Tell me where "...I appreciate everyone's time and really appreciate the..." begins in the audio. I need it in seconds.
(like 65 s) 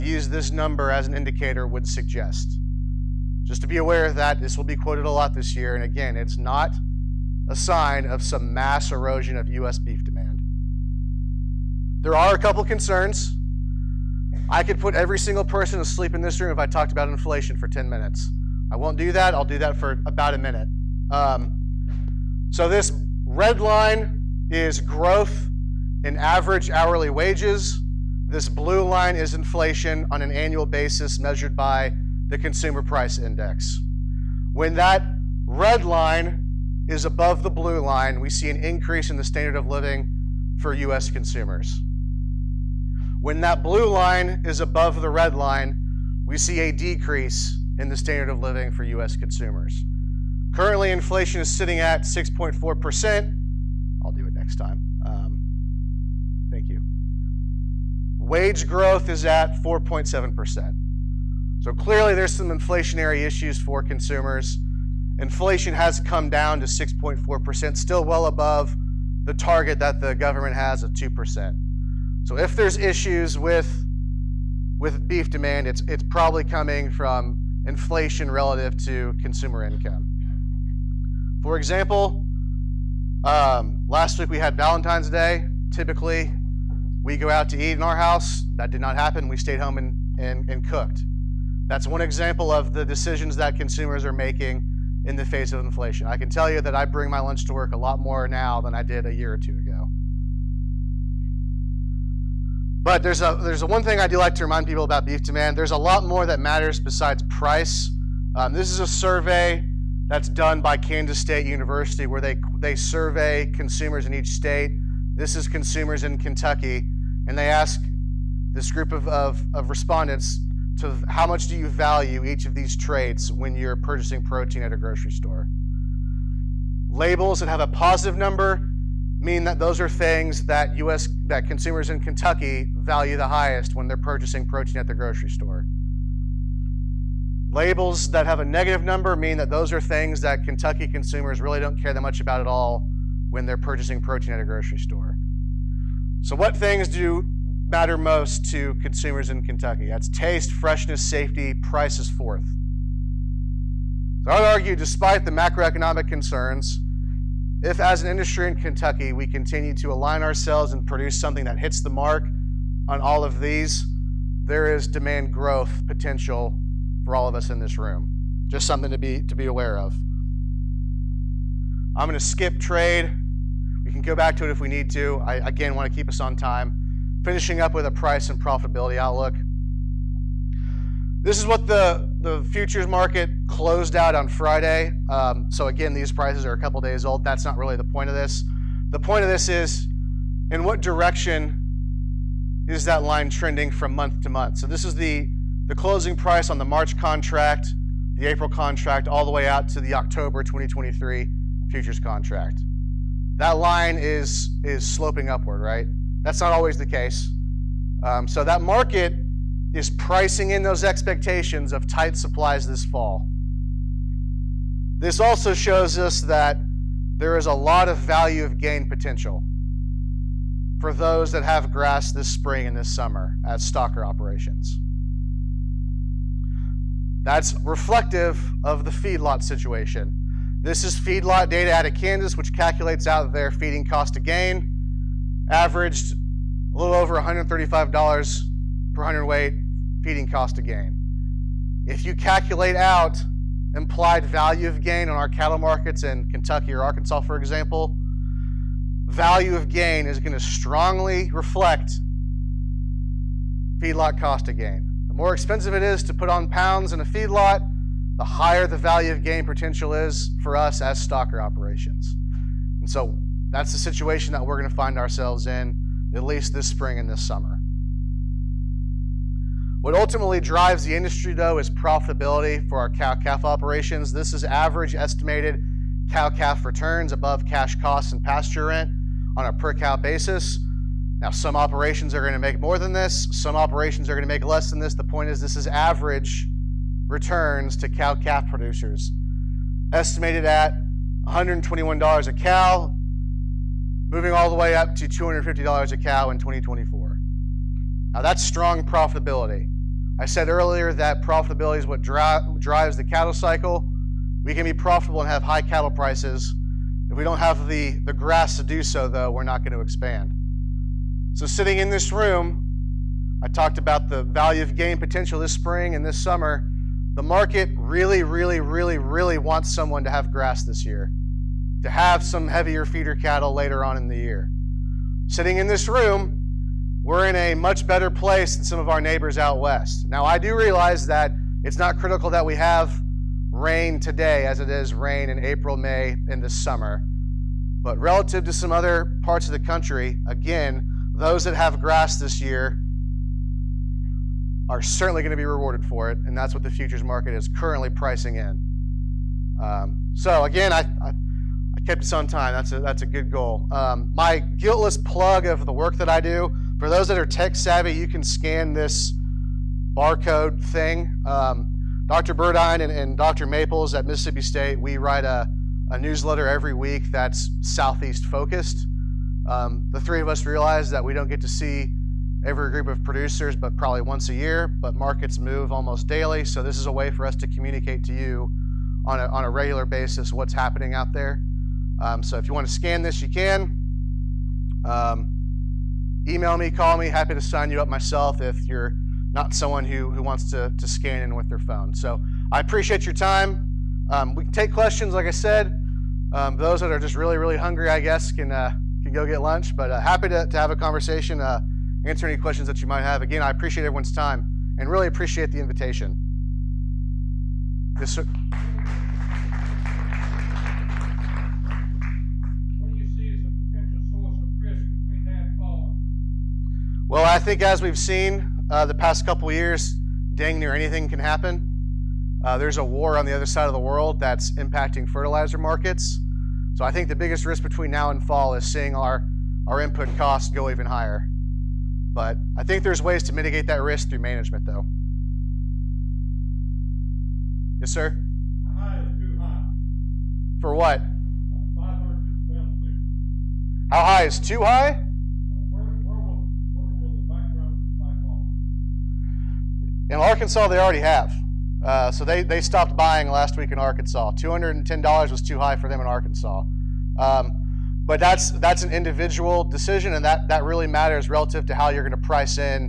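403 s.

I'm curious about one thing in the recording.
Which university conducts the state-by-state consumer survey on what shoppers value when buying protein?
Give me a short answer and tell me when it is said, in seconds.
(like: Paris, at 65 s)
Kansas State University, at 110 s.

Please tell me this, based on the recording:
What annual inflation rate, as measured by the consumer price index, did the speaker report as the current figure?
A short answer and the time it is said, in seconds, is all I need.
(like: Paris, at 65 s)
6.4%, at 50 s.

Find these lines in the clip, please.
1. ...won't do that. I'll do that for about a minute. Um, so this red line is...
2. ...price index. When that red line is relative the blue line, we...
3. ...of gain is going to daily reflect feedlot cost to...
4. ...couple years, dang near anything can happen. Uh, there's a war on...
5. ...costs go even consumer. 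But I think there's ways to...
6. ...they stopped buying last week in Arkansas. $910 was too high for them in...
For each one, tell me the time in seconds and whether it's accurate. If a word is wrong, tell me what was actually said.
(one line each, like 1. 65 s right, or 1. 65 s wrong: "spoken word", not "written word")
1. 18 s right
2. 32 s wrong: "above", not "relative"
3. 249 s wrong: "strongly", not "daily"
4. 419 s right
5. 430 s wrong: "higher", not "consumer"
6. 452 s wrong: "210", not "910".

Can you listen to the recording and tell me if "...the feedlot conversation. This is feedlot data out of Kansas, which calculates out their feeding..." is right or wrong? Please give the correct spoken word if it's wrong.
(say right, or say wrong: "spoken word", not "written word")
wrong: "situation", not "conversation".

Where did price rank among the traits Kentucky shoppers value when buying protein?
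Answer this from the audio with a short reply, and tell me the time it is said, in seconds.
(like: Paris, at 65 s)
Fourth, at 151 s.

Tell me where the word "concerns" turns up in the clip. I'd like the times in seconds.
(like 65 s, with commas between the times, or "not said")
12 s, 156 s.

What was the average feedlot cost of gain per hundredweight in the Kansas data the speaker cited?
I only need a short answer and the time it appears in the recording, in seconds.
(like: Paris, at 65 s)
$135, at 237 s.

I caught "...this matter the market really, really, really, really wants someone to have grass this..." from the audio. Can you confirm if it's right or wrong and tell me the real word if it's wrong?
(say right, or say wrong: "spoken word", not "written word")
wrong: "summer", not "matter".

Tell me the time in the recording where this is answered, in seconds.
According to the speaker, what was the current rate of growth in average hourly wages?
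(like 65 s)
58 s.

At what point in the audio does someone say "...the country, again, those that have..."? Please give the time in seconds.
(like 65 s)
339 s.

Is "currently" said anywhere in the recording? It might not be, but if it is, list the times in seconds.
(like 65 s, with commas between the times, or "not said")
50 s, 347 s.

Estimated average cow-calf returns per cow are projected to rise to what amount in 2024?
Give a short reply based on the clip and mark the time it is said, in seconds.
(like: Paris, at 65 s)
$250, at 295 s.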